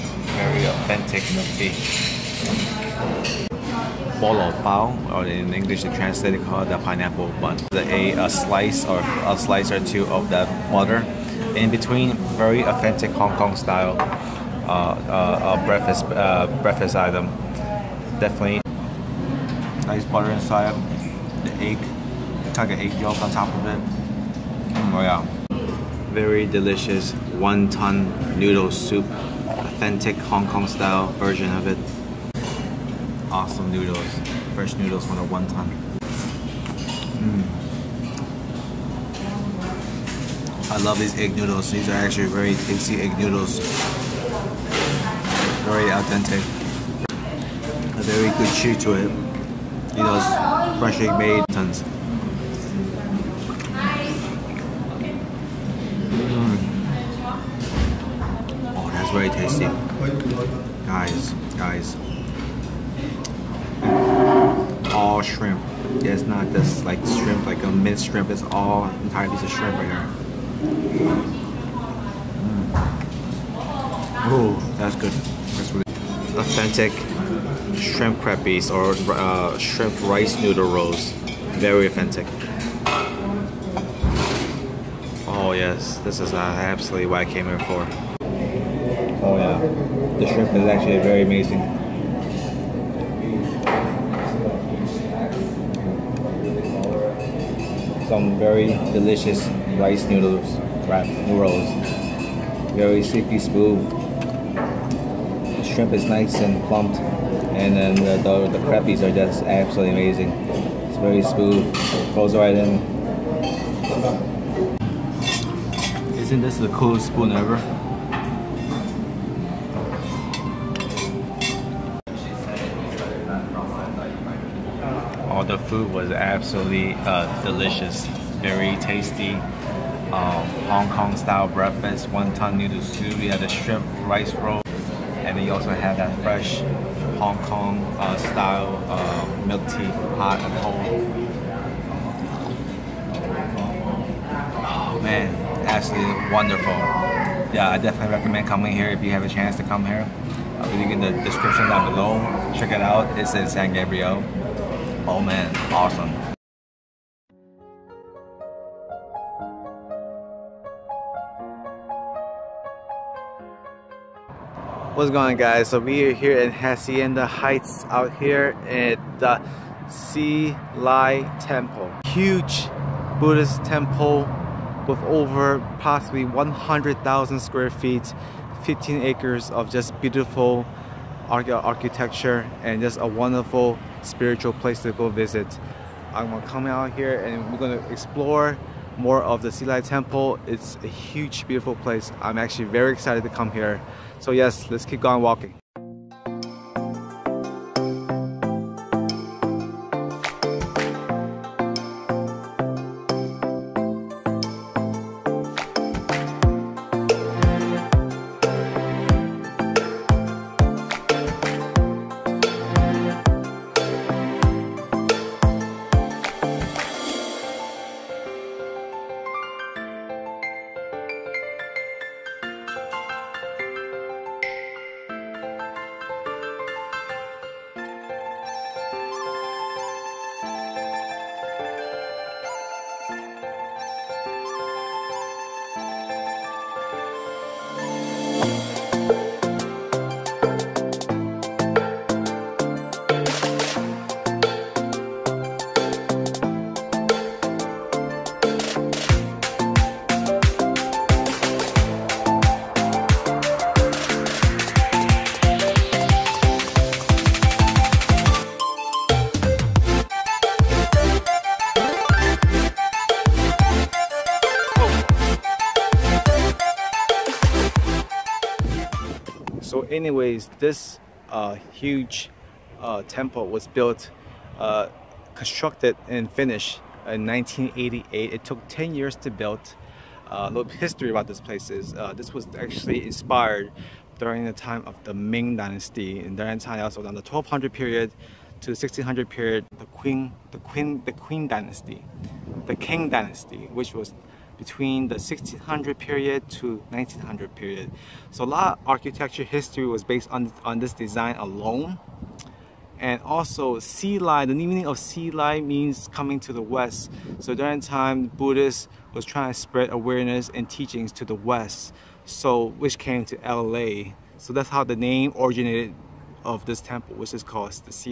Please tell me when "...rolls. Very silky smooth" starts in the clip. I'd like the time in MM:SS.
01:41.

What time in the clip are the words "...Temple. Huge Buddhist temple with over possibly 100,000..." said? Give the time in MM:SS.
02:51.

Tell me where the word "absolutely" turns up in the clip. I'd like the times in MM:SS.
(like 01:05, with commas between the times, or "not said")
01:26, 01:49, 02:06, 02:25.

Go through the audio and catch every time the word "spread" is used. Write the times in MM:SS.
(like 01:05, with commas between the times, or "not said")
05:09.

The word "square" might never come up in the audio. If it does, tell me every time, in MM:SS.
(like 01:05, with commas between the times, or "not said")
02:57.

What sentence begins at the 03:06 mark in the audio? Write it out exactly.
I'm gonna come out here and we're gonna explore more of the Hsi Lai Temple.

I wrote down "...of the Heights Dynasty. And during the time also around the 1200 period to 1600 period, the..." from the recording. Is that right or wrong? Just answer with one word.
wrong.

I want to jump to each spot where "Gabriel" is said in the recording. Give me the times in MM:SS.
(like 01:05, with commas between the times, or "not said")
02:33.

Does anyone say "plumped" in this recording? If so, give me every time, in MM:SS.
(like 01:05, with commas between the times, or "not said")
01:46.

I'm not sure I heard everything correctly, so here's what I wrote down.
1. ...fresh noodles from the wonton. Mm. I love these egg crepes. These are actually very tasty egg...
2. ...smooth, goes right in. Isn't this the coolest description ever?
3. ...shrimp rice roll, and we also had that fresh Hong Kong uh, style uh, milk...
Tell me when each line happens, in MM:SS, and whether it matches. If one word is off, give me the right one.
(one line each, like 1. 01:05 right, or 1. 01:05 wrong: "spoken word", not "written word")
1. 00:34 wrong: "noodles", not "crepes"
2. 01:51 wrong: "spoon", not "description"
3. 02:13 right.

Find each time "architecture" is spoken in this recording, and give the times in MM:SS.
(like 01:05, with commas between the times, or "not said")
03:01, 04:58.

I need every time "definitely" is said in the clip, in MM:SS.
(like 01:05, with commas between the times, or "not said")
00:18, 02:27.